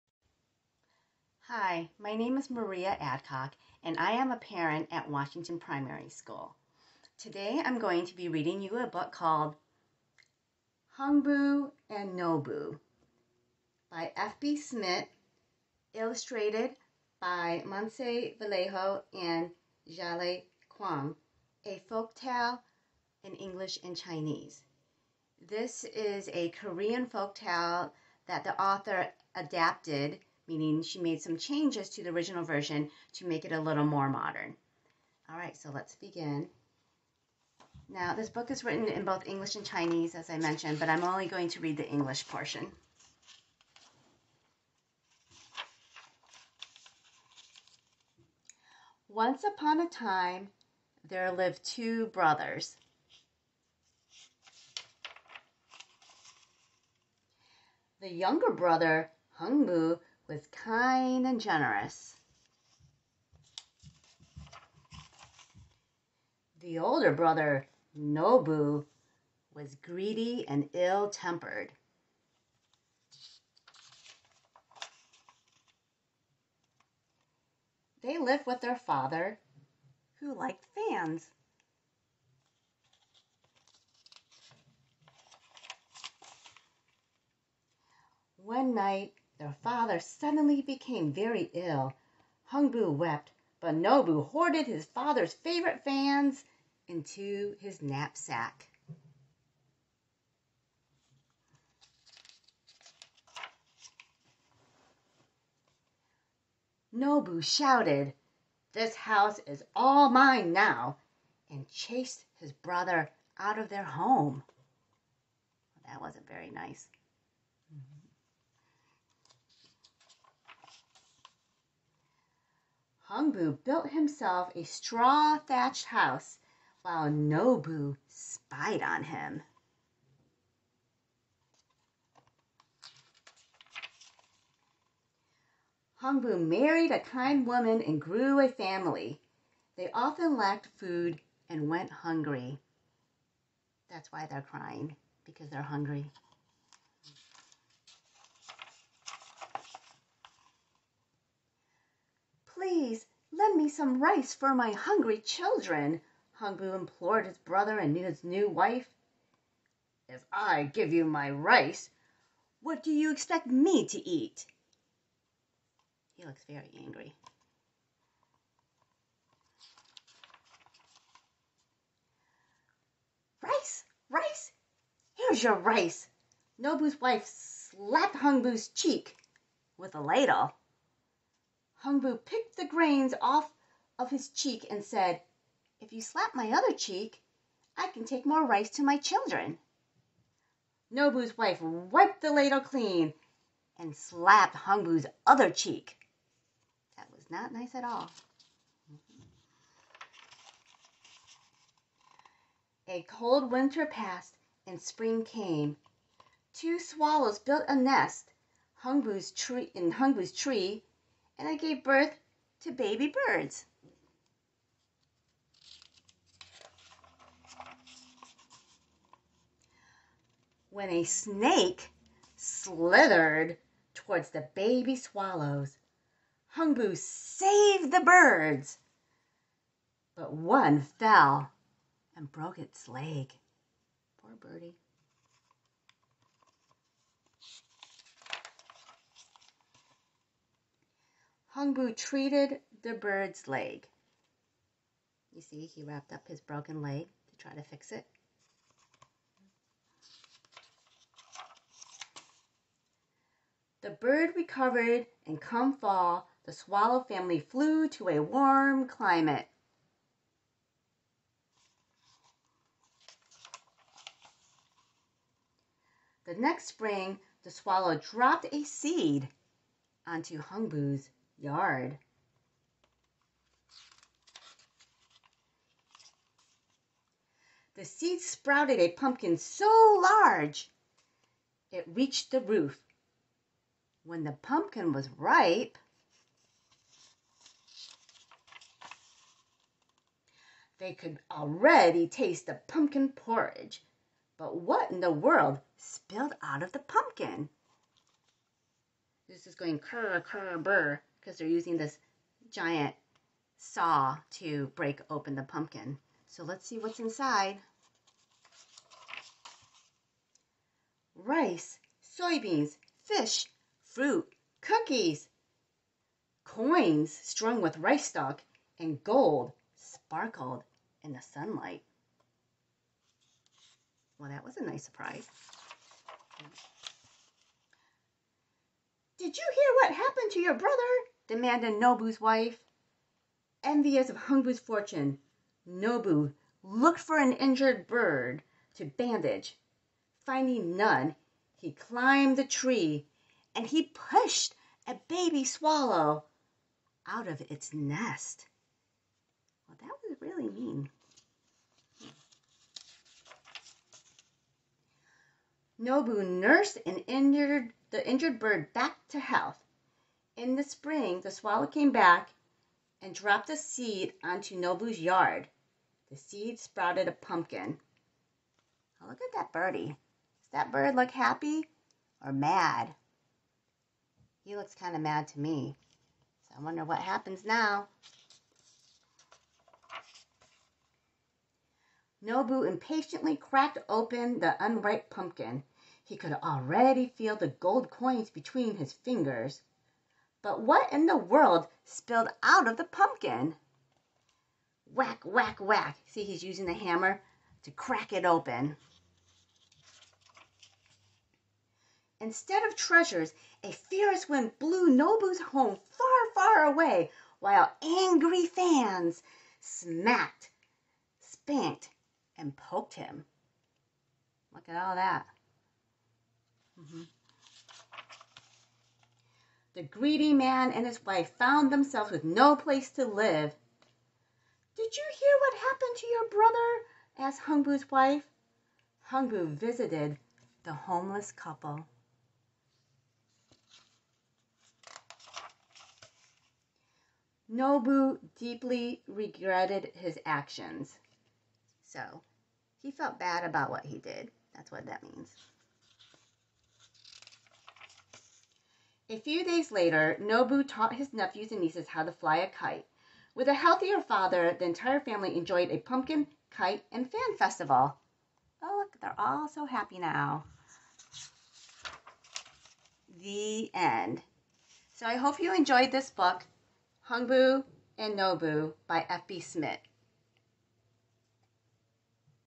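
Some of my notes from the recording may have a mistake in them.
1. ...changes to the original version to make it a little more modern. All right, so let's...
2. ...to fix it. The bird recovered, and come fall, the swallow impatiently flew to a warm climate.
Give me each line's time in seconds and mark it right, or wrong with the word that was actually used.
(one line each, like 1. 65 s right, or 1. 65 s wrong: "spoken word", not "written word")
1. 31 s right
2. 247 s wrong: "family", not "impatiently".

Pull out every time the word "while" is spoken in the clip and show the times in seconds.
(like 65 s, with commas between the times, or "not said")
126 s, 407 s.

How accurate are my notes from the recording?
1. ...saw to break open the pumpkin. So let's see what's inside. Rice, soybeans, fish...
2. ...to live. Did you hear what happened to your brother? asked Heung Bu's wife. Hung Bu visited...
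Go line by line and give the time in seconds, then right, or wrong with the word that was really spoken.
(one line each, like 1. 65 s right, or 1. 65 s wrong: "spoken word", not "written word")
1. 303 s right
2. 422 s right.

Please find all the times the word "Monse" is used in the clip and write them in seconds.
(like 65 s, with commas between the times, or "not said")
17 s.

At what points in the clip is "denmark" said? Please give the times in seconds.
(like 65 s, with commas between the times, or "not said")
not said.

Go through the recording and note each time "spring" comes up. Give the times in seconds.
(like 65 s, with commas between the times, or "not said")
204 s, 266 s, 360 s.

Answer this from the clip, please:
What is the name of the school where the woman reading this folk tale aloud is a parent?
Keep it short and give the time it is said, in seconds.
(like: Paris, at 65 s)
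Washington Primary School, at 5 s.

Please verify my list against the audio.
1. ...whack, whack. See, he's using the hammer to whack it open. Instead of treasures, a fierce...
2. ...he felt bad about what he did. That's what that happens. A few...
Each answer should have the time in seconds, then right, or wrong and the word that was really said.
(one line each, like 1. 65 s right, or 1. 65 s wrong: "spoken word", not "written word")
1. 395 s wrong: "crack", not "whack"
2. 442 s wrong: "means", not "happens".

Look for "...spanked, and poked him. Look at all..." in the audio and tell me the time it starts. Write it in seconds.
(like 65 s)
411 s.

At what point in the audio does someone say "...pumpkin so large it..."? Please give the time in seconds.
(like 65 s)
278 s.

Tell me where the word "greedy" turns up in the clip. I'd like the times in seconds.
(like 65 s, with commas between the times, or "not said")
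69 s, 419 s.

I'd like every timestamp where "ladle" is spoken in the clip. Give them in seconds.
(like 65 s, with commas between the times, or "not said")
180 s, 192 s.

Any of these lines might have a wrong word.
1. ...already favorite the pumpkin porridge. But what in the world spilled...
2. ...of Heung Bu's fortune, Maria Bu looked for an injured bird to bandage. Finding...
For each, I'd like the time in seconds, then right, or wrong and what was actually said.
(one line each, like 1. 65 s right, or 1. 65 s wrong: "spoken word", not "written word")
1. 291 s wrong: "taste", not "favorite"
2. 334 s wrong: "Nol", not "Maria".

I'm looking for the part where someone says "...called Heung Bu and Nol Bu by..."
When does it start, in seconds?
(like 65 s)
9 s.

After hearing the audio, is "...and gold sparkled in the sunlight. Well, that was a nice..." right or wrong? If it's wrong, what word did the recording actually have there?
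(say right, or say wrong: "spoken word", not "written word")
right.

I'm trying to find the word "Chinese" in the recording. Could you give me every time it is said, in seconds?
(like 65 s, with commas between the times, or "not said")
23 s, 39 s.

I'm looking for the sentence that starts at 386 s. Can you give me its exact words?
He could already feel the gold coins between his fingers.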